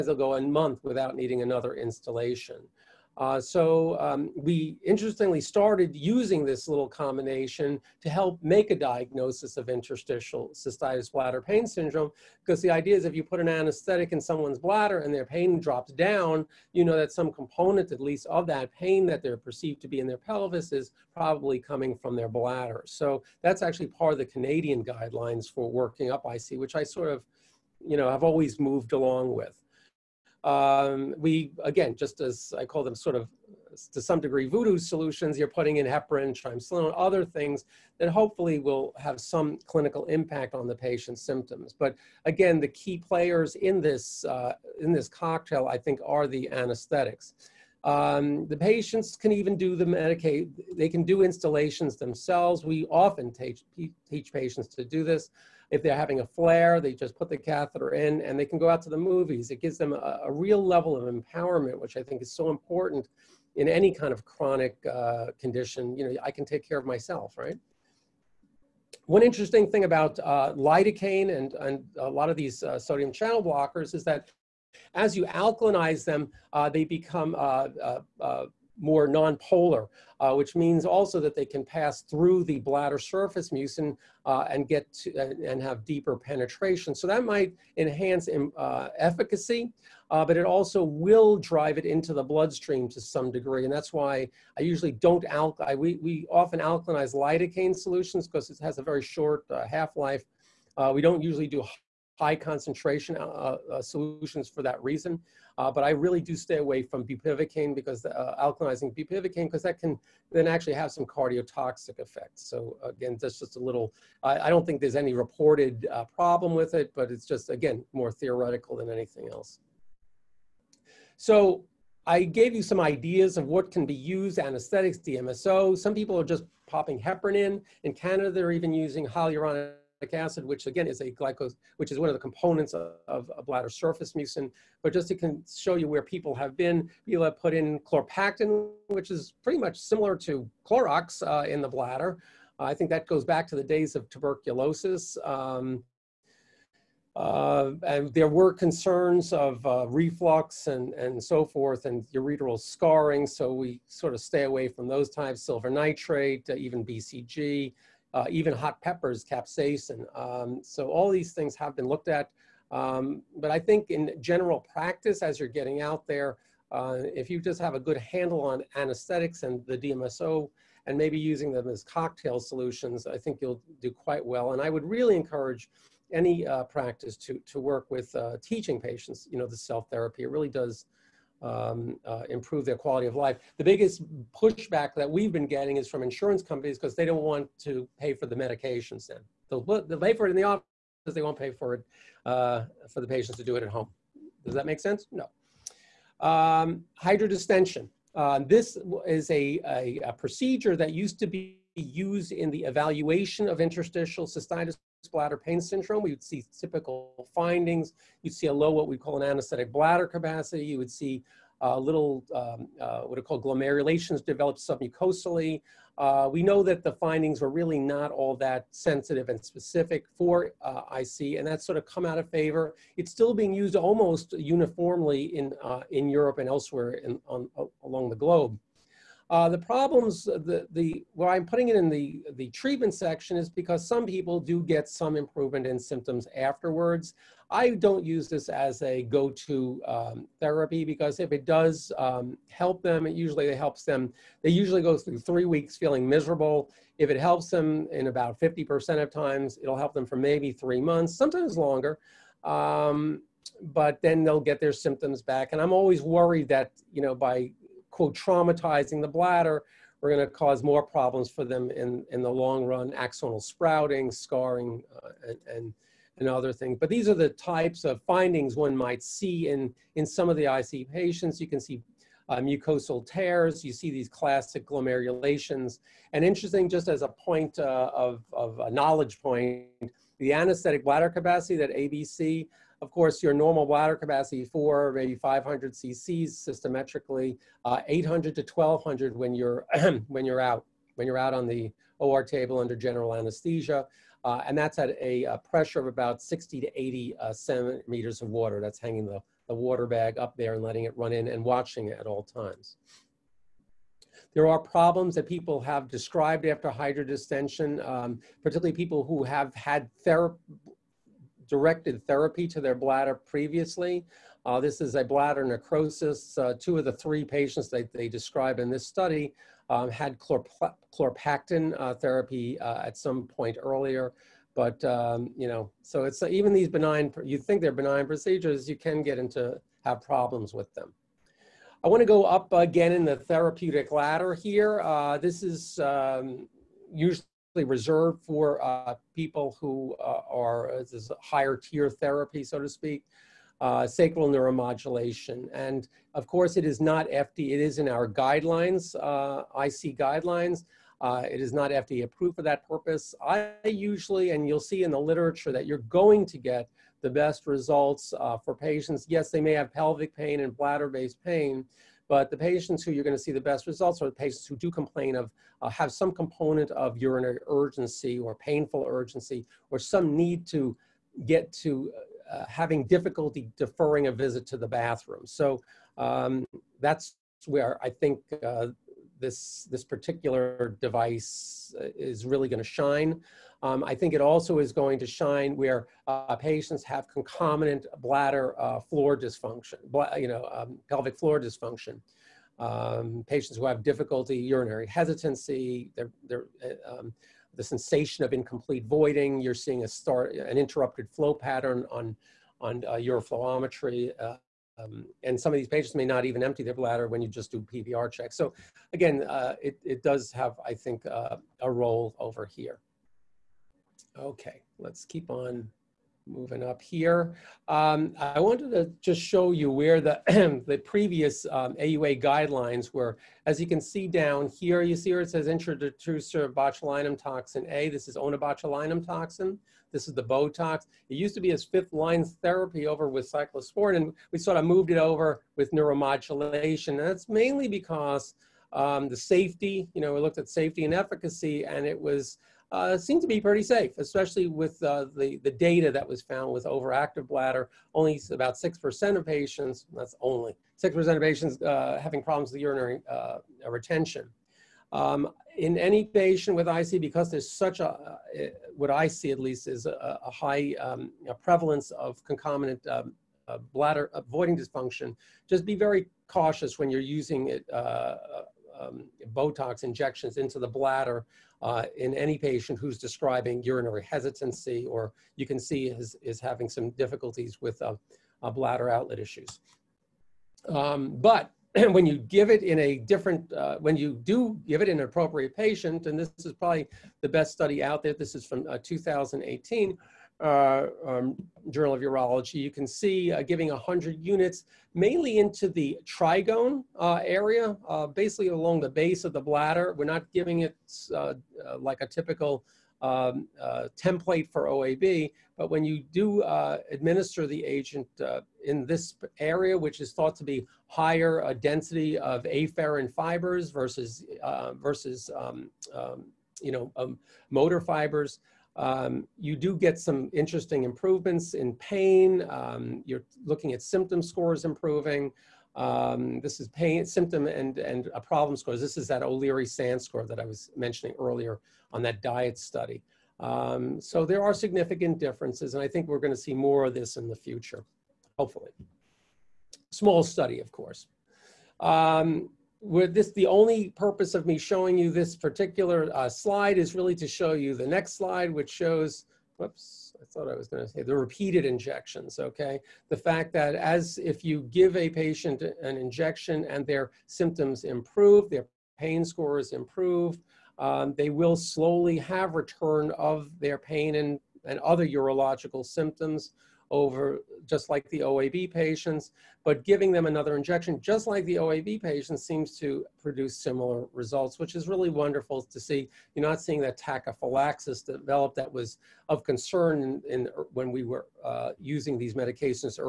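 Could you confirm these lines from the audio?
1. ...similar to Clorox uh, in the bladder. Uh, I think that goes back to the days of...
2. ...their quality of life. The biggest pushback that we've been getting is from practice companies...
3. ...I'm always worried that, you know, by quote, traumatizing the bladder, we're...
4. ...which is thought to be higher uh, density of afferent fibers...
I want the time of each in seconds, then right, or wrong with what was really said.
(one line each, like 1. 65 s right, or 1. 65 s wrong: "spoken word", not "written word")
1. 139 s right
2. 182 s wrong: "insurance", not "practice"
3. 255 s right
4. 509 s right.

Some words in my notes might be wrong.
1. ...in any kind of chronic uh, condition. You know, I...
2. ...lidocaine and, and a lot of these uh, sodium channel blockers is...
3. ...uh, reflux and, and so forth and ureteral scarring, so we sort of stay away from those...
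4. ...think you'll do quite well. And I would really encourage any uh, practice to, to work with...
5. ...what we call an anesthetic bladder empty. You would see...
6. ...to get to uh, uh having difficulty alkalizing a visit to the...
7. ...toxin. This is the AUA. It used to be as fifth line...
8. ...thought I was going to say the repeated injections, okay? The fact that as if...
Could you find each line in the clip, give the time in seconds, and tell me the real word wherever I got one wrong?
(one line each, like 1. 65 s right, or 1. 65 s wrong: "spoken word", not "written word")
1. 63 s right
2. 70 s right
3. 149 s right
4. 173 s right
5. 208 s wrong: "capacity", not "empty"
6. 370 s wrong: "deferring", not "alkalizing"
7. 429 s wrong: "Botox", not "AUA"
8. 550 s right.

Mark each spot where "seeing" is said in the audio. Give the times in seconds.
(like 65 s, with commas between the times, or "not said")
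399 s, 576 s.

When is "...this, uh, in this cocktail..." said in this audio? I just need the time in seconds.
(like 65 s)
43 s.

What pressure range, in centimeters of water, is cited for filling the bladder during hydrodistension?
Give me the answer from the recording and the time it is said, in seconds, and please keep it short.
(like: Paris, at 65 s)
60 to 80, at 296 s.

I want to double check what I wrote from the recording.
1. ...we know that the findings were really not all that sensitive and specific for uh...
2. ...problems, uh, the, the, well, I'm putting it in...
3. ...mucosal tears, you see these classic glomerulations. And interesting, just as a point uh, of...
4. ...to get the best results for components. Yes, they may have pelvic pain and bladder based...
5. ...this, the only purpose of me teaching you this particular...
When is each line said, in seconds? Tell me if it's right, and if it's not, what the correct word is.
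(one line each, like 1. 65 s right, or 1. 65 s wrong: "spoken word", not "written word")
1. 216 s right
2. 229 s right
3. 272 s right
4. 356 s wrong: "patients", not "components"
5. 543 s wrong: "showing", not "teaching".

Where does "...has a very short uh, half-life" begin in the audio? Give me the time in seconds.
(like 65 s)
98 s.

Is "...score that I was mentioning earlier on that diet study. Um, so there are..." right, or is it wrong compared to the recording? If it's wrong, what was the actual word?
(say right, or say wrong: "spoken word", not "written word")
right.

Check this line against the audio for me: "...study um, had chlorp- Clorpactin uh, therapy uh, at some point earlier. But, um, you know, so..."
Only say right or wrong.
right.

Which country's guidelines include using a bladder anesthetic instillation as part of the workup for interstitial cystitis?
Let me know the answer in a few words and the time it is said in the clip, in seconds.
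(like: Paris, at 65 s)
Canadian, at 24 s.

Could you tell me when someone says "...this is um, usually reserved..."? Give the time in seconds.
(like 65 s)
335 s.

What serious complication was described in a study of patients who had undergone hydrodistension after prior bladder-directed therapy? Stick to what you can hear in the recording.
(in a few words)
bladder necrosis.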